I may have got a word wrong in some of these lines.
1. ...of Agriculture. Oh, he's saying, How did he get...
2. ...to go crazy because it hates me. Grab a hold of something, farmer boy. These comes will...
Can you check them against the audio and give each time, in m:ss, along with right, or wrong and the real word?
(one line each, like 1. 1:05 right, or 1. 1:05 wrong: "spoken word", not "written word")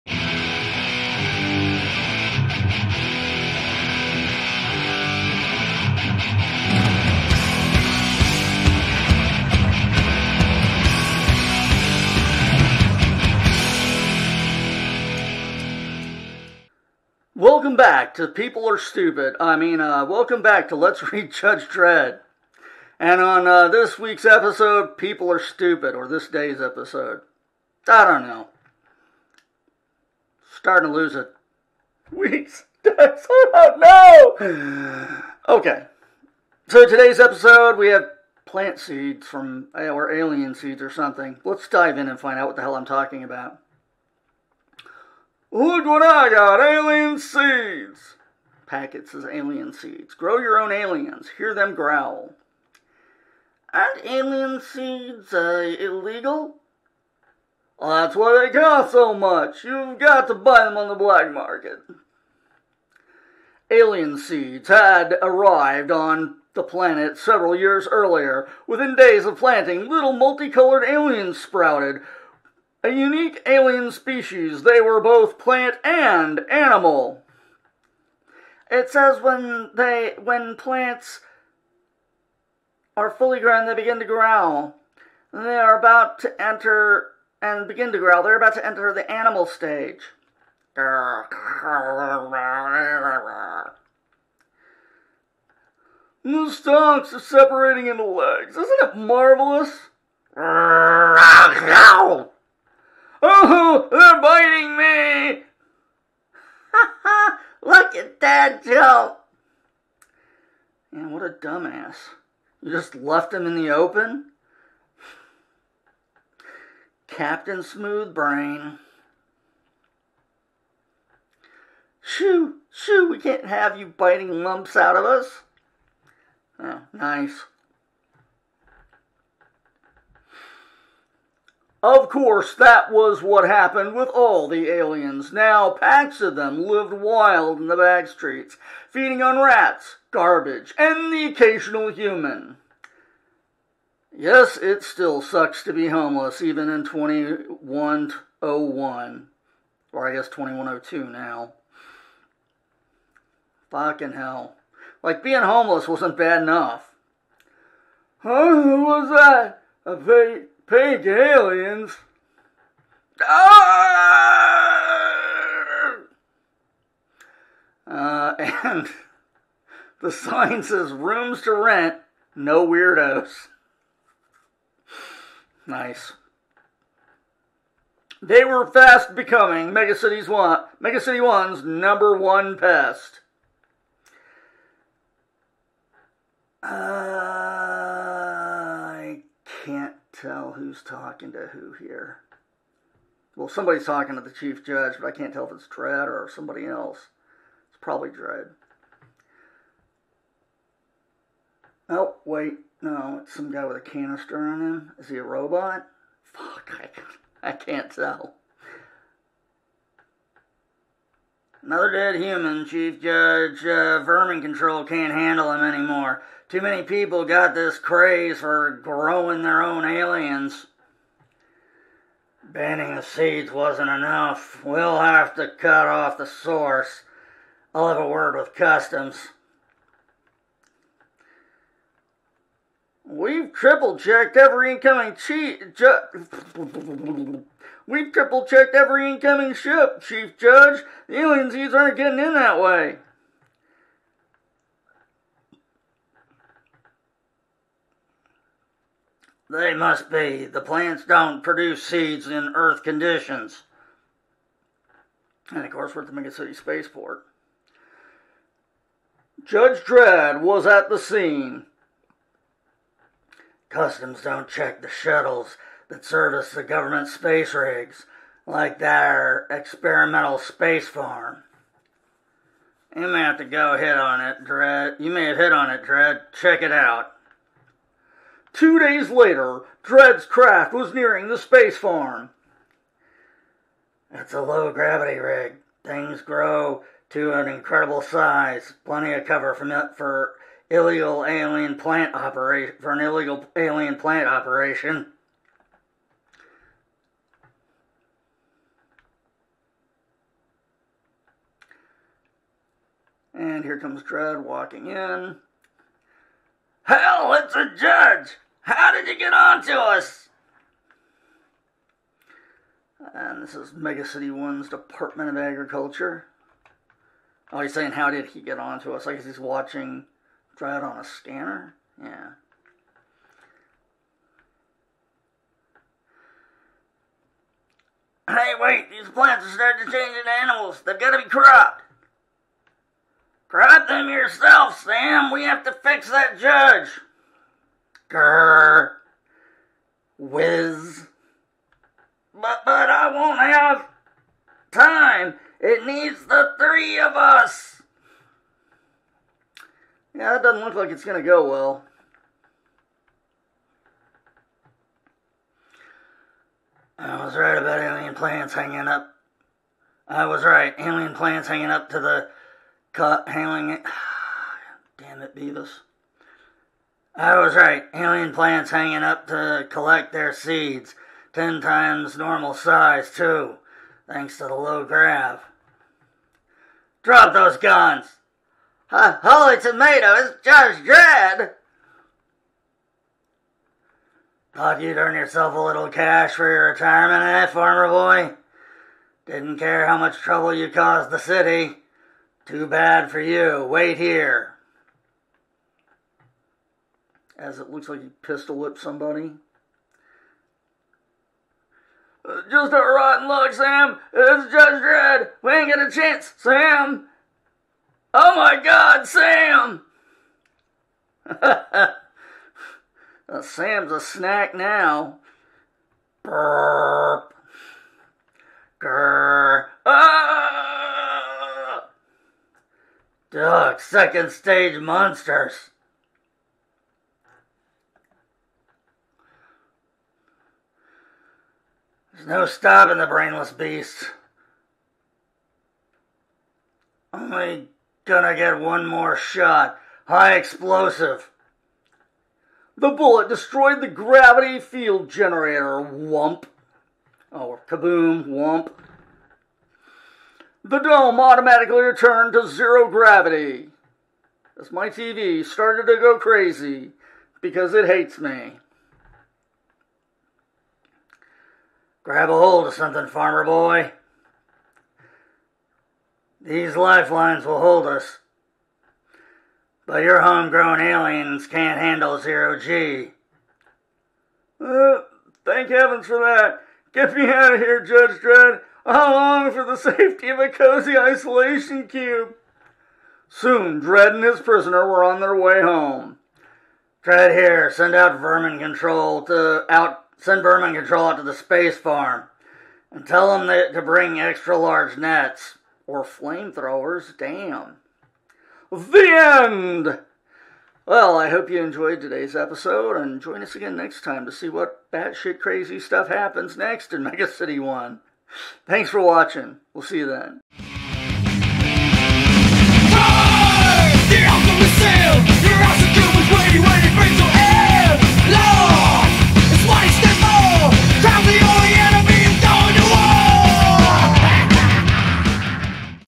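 1. 5:15 right
2. 7:35 wrong: "lifelines", not "comes".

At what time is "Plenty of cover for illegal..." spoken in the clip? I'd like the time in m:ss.
4:48.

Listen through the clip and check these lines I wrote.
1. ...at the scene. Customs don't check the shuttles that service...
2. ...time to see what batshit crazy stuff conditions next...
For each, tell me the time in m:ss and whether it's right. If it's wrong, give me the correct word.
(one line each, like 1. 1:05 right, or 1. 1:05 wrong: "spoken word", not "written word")
1. 4:20 right
2. 8:24 wrong: "happens", not "conditions".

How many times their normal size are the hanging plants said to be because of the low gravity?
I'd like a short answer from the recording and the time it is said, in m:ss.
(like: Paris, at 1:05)
10, at 6:11.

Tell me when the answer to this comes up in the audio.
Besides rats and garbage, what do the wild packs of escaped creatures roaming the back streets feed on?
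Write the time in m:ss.
2:21.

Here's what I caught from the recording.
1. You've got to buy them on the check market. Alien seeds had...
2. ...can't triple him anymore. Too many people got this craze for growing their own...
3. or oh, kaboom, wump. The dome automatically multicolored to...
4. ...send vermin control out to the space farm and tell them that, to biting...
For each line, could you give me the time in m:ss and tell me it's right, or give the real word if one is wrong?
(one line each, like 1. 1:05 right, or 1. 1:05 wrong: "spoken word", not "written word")
1. 0:59 wrong: "black", not "check"
2. 3:34 wrong: "handle", not "triple"
3. 7:27 wrong: "returned", not "multicolored"
4. 8:10 wrong: "bring", not "biting".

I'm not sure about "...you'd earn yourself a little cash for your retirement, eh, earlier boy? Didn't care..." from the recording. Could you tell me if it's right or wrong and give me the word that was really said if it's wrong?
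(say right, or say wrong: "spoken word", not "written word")
wrong: "farmer", not "earlier".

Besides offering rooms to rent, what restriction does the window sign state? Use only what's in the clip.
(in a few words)
no weirdos.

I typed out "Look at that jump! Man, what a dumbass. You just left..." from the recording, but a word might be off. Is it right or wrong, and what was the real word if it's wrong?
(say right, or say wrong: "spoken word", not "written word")
right.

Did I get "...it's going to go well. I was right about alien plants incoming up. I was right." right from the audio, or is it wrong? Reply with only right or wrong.
wrong.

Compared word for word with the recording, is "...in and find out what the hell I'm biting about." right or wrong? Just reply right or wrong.
wrong.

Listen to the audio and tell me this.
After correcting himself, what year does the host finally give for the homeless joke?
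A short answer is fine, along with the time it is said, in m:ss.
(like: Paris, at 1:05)
2102, at 2:30.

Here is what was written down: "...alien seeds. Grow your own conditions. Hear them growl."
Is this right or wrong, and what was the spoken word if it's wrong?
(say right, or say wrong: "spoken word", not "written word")
wrong: "aliens", not "conditions".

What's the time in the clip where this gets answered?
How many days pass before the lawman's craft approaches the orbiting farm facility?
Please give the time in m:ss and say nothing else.
4:38.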